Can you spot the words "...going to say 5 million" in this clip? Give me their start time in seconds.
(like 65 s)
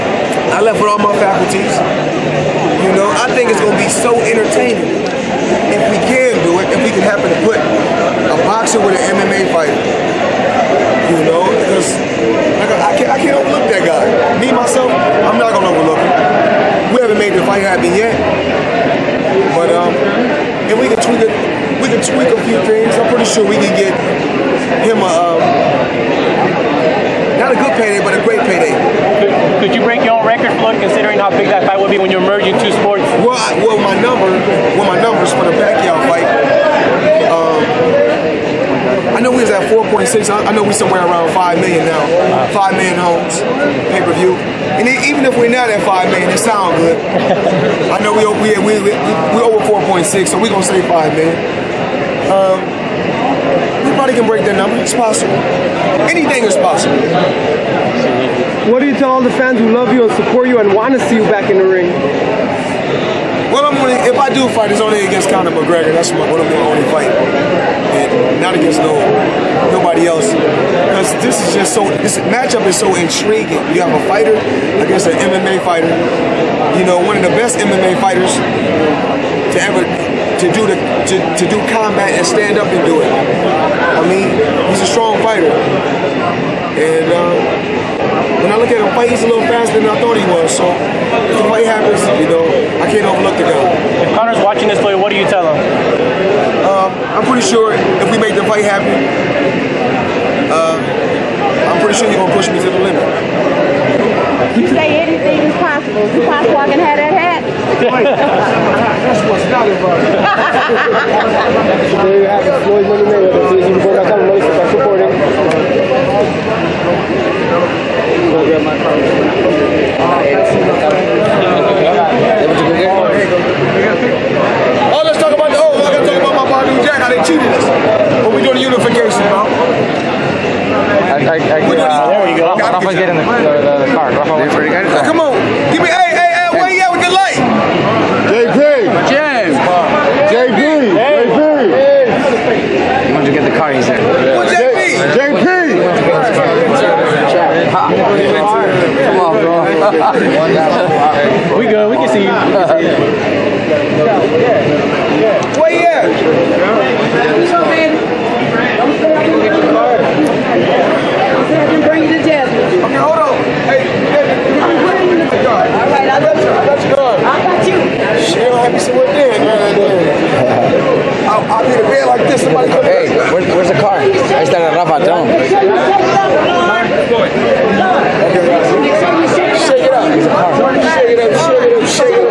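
50 s.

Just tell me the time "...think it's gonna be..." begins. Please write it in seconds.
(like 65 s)
3 s.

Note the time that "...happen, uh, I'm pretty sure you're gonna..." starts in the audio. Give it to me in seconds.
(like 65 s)
98 s.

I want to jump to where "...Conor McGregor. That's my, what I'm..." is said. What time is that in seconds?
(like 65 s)
65 s.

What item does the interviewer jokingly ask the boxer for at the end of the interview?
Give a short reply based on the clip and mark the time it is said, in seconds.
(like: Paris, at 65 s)
That hat, at 107 s.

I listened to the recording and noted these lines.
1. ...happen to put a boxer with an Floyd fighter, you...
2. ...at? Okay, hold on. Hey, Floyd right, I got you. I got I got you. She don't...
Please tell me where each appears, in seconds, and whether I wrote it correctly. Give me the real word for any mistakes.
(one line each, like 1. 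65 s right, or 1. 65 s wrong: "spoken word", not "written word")
1. 7 s wrong: "MMA", not "Floyd"
2. 155 s wrong: "All", not "Floyd".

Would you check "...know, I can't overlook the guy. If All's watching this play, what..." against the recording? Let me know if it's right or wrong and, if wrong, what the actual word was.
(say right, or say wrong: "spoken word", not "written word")
wrong: "Conor", not "All".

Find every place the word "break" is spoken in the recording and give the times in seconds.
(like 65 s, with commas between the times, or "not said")
29 s, 54 s.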